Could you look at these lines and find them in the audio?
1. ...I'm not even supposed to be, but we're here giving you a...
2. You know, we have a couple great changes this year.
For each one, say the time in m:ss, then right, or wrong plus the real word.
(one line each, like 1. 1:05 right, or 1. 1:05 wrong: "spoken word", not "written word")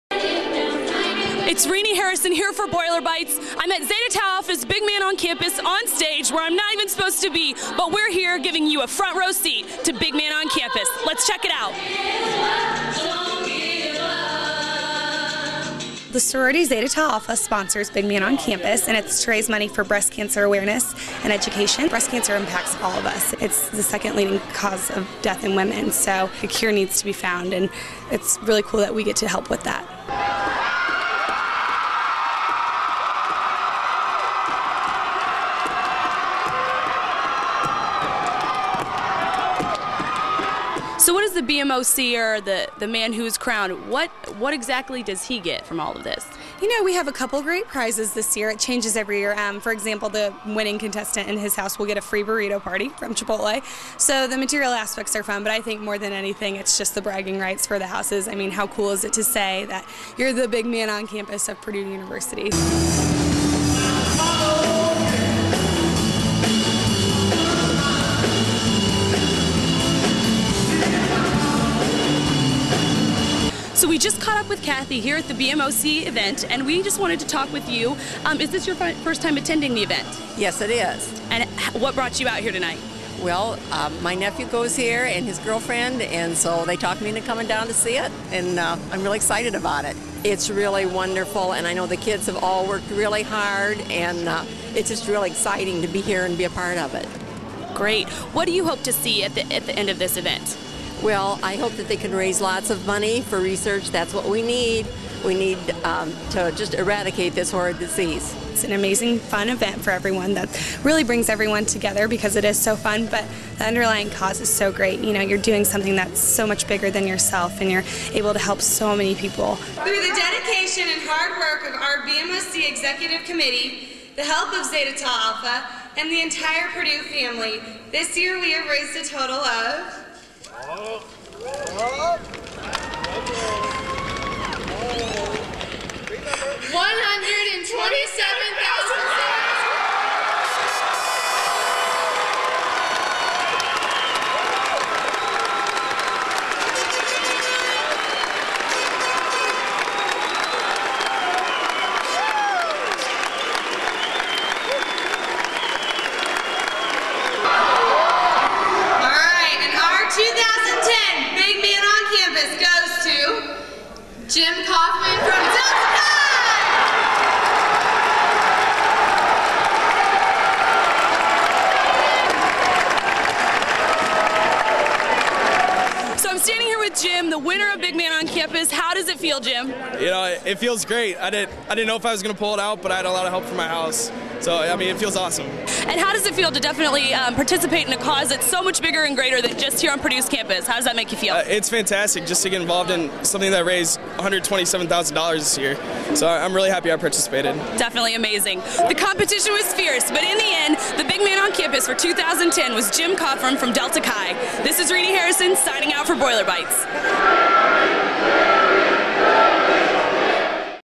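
1. 0:06 right
2. 0:46 wrong: "prizes", not "changes".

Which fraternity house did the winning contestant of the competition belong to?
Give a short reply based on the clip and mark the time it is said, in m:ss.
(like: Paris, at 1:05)
Delta Chi, at 3:23.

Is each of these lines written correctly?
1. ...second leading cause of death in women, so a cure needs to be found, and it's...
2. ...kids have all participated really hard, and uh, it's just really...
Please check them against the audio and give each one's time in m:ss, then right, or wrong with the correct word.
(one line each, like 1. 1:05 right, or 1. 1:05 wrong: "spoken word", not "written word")
1. 0:23 right
2. 1:31 wrong: "worked", not "participated".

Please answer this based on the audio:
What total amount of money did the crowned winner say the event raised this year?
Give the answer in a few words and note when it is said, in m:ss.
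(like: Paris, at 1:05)
$127,000, at 3:14.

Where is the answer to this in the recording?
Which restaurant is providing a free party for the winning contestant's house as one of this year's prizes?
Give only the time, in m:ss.
0:53.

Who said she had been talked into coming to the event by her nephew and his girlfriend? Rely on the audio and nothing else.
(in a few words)
Kathy.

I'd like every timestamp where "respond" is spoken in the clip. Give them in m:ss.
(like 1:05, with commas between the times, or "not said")
not said.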